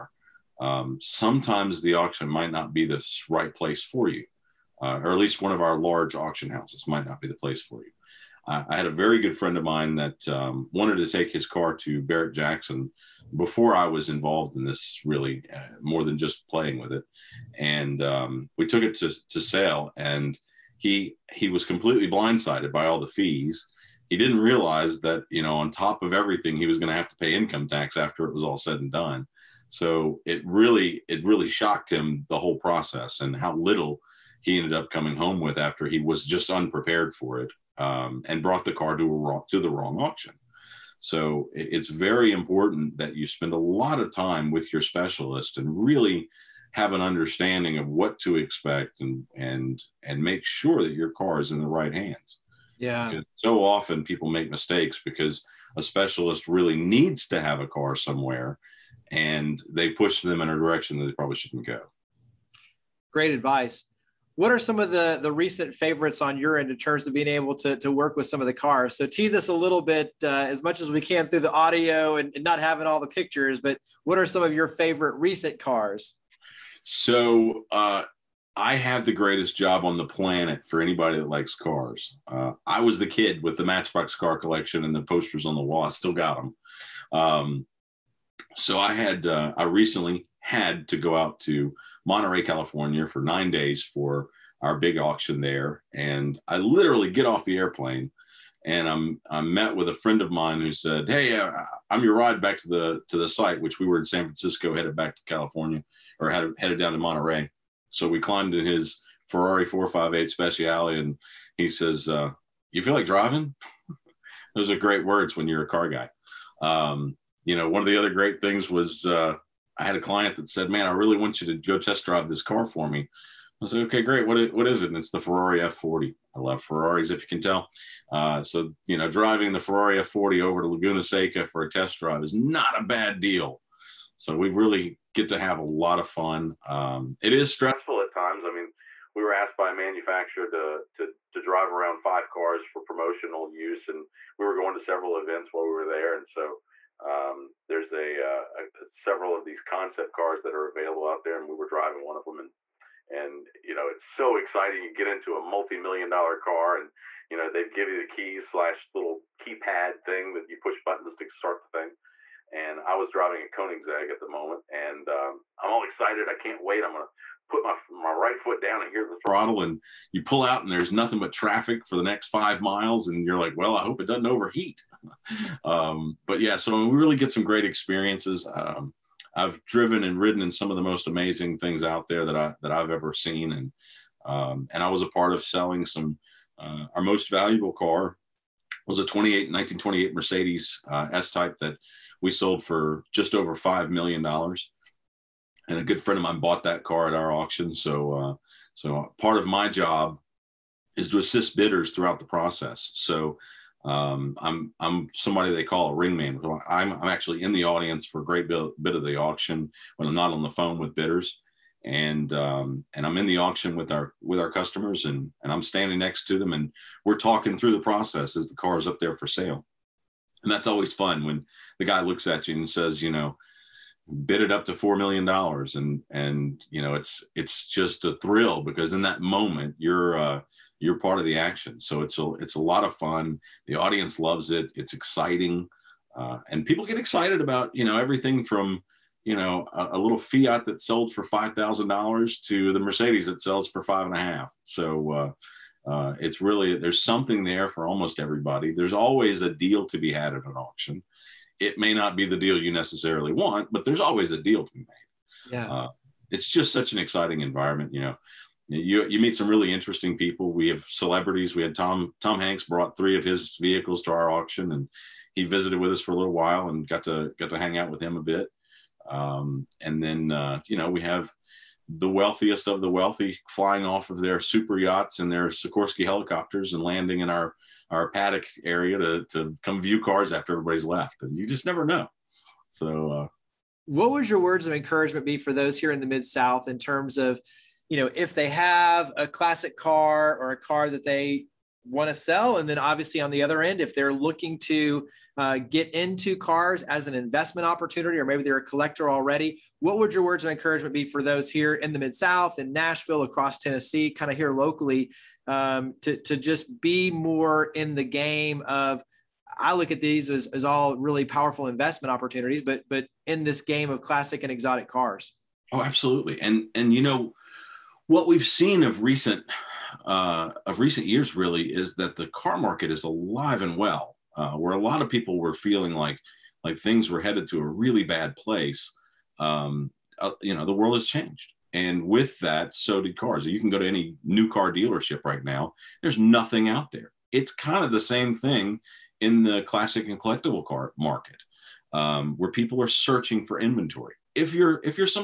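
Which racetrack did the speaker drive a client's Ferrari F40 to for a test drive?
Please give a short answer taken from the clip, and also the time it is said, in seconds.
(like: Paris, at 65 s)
Laguna Seca, at 130 s.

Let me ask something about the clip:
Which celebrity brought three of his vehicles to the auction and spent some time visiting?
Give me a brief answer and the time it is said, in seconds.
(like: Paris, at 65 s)
Tom Hanks, at 261 s.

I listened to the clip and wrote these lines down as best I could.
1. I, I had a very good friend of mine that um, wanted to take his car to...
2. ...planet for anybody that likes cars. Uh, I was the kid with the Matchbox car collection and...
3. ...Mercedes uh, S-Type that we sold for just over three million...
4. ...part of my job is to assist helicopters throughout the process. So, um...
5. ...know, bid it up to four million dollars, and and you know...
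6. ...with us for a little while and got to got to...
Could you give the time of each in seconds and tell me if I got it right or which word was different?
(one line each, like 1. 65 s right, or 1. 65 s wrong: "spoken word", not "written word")
1. 8 s right
2. 80 s right
3. 190 s wrong: "five", not "three"
4. 199 s wrong: "bidders", not "helicopters"
5. 223 s right
6. 265 s right.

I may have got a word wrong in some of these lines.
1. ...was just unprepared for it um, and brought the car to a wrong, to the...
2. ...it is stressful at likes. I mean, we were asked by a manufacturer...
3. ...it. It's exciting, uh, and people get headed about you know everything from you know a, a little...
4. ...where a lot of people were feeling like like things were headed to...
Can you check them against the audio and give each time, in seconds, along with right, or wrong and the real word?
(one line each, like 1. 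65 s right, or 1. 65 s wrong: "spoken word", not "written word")
1. 35 s right
2. 137 s wrong: "times", not "likes"
3. 234 s wrong: "excited", not "headed"
4. 324 s right.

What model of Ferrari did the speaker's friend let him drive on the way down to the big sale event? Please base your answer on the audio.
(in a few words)
458 Speciale.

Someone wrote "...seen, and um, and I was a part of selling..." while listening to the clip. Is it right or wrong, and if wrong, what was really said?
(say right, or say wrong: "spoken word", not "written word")
right.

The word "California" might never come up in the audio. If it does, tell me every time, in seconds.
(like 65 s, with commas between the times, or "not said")
92 s, 105 s.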